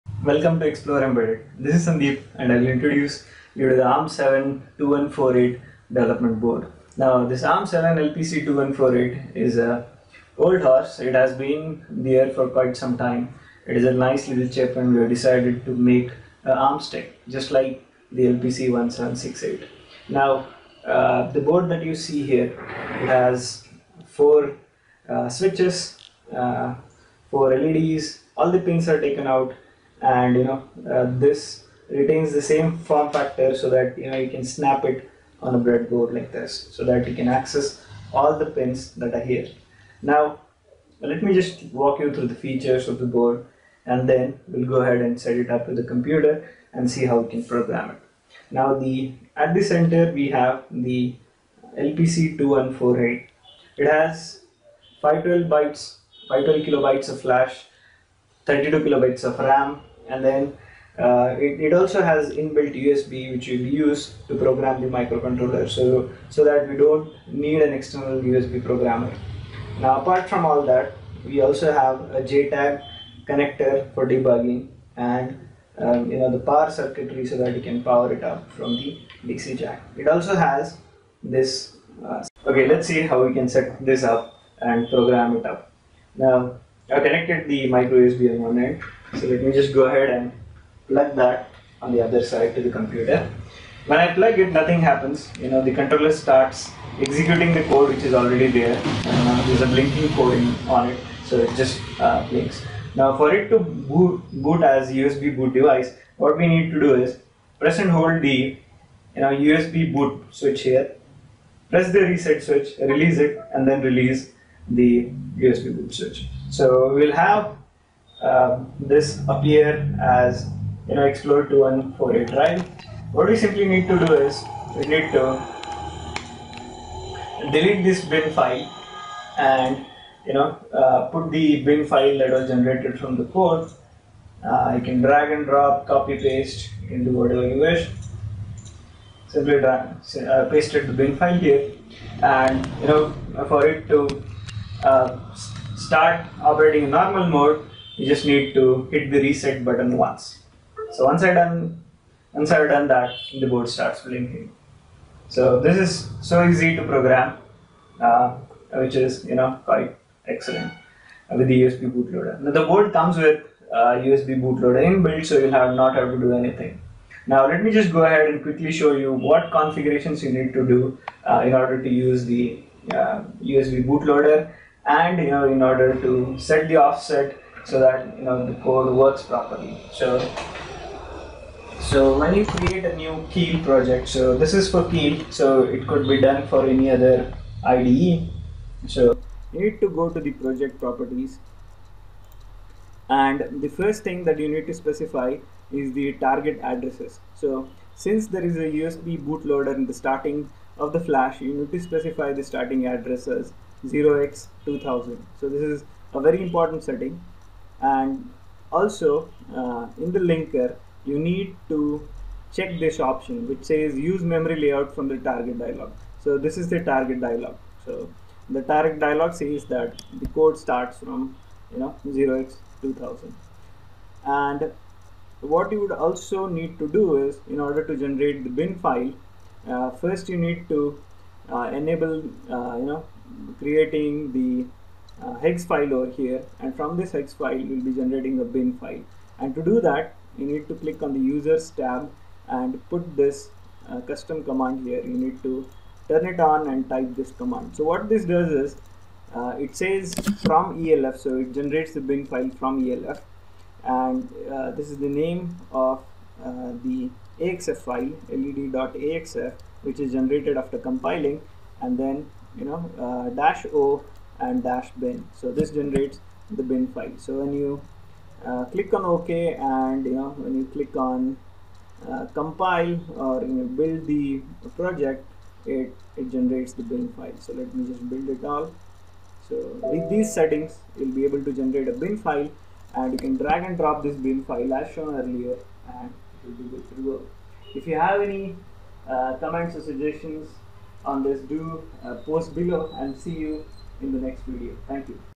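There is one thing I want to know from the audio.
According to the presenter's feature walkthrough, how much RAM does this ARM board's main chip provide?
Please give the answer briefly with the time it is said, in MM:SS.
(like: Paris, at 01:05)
32 kilobytes, at 00:58.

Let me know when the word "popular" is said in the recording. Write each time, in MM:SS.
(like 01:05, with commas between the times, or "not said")
not said.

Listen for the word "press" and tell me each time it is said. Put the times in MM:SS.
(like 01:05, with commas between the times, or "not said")
01:47, 01:51.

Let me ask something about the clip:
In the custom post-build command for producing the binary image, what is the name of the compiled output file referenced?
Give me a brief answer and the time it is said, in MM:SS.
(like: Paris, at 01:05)
led.axf, at 04:18.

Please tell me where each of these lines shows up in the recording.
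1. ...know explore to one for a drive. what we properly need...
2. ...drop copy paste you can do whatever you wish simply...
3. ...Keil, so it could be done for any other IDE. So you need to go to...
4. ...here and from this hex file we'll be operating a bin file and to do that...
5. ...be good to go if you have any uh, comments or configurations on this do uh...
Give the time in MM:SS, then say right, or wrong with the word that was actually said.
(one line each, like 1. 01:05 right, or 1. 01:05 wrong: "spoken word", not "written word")
1. 02:00 wrong: "simply", not "properly"
2. 02:15 right
3. 03:04 right
4. 03:56 wrong: "generating", not "operating"
5. 04:46 wrong: "suggestions", not "configurations".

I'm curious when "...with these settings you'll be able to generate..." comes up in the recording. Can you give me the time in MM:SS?
04:39.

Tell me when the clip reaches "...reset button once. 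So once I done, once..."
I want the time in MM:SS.
02:29.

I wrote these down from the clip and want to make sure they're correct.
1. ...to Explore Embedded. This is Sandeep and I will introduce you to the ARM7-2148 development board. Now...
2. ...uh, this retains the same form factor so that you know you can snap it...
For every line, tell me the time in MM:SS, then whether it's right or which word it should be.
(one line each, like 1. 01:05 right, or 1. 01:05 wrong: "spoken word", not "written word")
1. 00:00 right
2. 00:30 right.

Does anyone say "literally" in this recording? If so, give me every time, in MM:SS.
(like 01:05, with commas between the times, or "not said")
not said.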